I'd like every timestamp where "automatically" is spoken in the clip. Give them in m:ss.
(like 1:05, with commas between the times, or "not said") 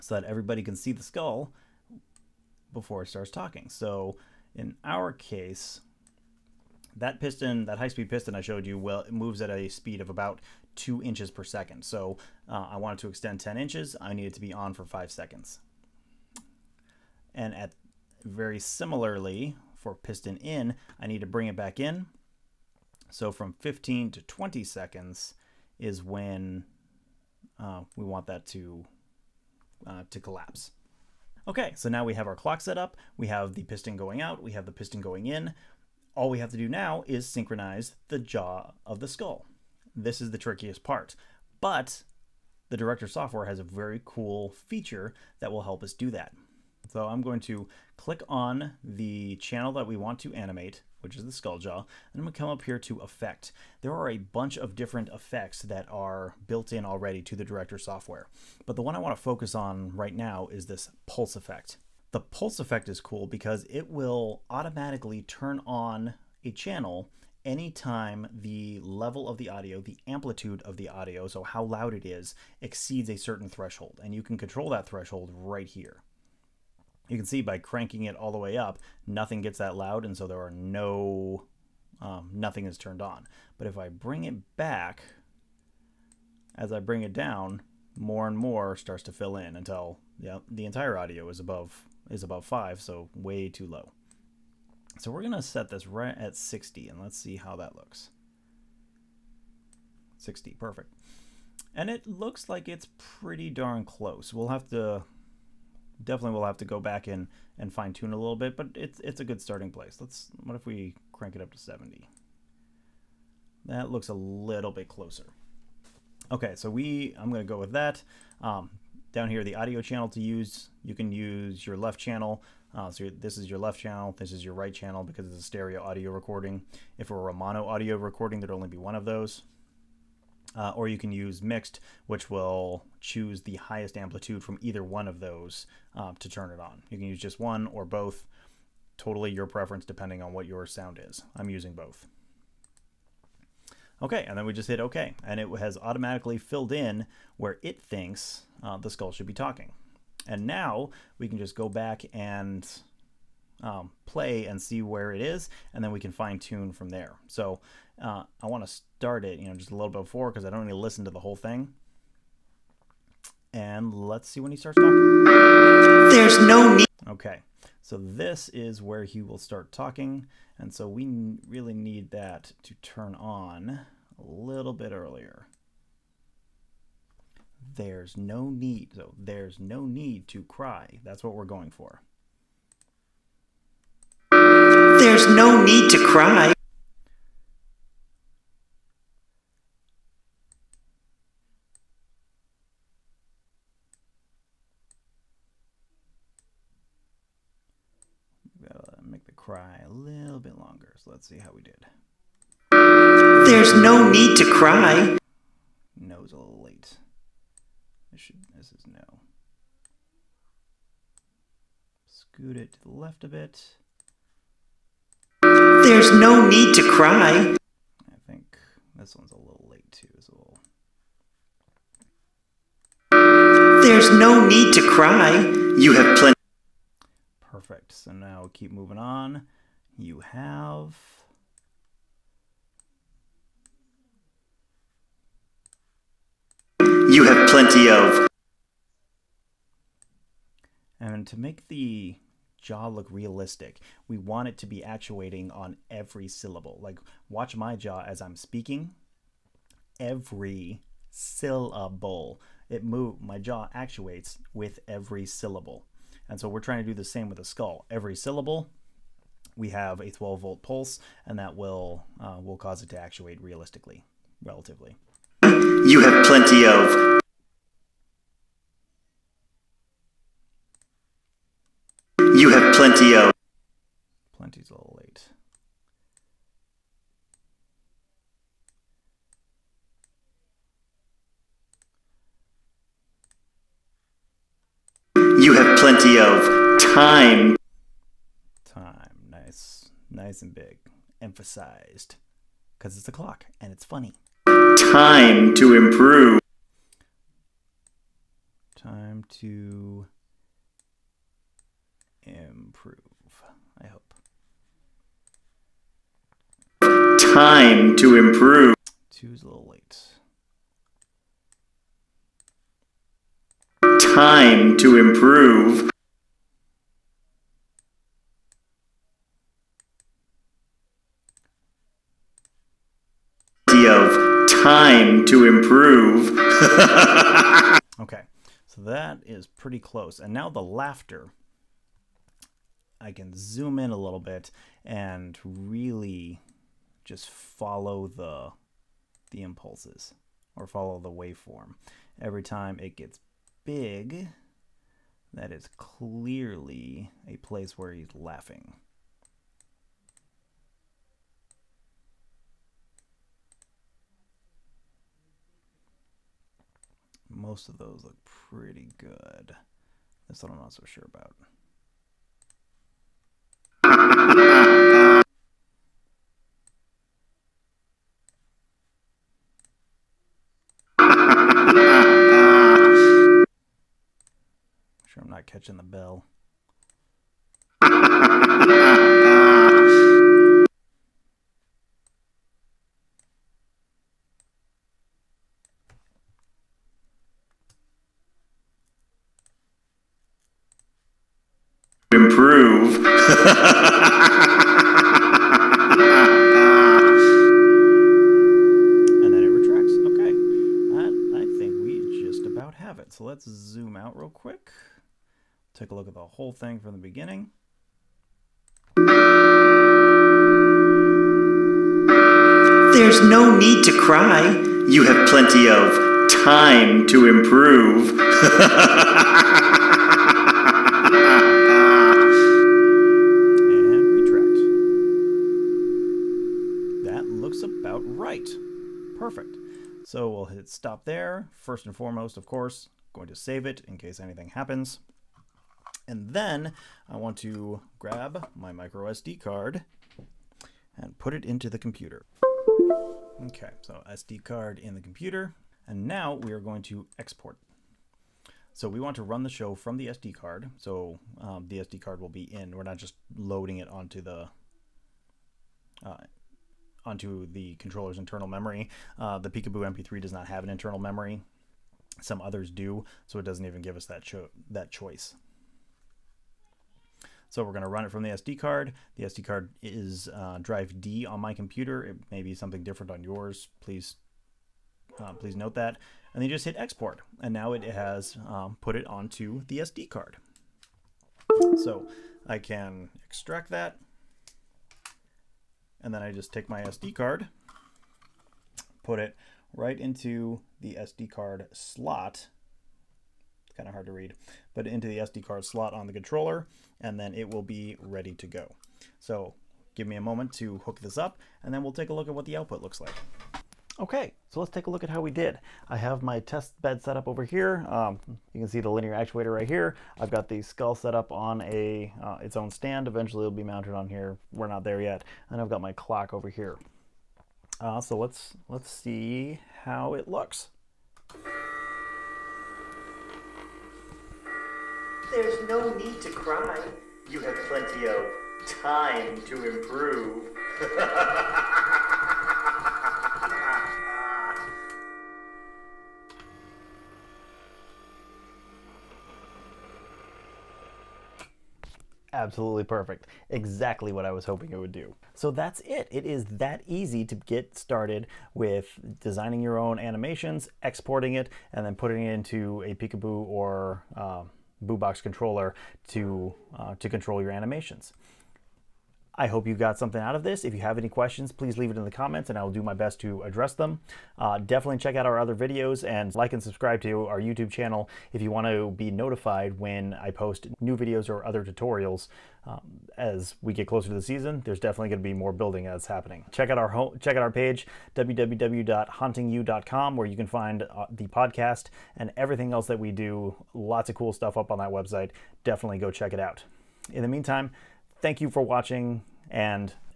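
1:04, 2:25.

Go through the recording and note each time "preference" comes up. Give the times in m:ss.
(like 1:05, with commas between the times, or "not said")
2:19.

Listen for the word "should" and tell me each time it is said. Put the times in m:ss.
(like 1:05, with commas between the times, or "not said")
2:29, 3:28.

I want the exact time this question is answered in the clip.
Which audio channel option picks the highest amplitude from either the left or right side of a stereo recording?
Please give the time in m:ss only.
2:11.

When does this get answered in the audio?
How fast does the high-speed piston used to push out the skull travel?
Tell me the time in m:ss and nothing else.
0:10.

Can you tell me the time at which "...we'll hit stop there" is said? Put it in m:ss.
7:10.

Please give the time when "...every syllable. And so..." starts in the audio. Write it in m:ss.
4:14.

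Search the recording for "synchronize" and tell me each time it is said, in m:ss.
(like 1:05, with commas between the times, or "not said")
0:37.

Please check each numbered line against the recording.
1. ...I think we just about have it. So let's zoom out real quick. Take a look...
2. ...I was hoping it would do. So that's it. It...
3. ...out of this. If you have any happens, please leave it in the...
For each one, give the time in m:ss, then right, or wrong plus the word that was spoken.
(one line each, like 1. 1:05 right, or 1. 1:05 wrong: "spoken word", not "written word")
1. 6:41 right
2. 9:04 right
3. 9:20 wrong: "questions", not "happens".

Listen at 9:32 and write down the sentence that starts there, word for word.
Um, as we get closer to the season, there's definitely going to be more building that's happening.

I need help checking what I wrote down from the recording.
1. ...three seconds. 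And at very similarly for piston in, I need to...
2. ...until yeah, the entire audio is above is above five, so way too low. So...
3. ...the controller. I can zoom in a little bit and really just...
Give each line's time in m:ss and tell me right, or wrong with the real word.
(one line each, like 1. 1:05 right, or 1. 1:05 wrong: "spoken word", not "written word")
1. 0:14 wrong: "five", not "three"
2. 1:29 right
3. 5:30 wrong: "laughter", not "controller".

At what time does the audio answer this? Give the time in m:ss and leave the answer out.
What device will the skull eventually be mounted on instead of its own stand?
8:28.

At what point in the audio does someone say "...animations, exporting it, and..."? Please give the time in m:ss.
9:09.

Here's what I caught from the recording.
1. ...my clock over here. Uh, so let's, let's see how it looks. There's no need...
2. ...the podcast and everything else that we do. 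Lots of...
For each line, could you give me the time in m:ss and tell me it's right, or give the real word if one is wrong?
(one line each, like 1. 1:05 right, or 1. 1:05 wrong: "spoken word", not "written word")
1. 8:35 right
2. 9:41 right.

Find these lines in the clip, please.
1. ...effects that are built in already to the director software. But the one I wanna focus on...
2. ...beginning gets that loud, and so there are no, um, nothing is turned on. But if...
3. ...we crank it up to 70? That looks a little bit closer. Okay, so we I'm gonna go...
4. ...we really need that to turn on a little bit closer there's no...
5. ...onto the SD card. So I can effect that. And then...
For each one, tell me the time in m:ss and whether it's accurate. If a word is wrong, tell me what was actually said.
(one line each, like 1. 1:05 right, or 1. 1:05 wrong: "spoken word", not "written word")
1. 0:55 right
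2. 1:19 wrong: "nothing", not "beginning"
3. 1:50 right
4. 2:50 wrong: "earlier", not "closer"
5. 7:59 wrong: "extract", not "effect".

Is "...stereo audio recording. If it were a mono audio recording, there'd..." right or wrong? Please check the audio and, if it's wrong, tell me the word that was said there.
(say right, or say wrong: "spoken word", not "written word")
right.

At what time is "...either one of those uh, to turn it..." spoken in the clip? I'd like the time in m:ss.
2:14.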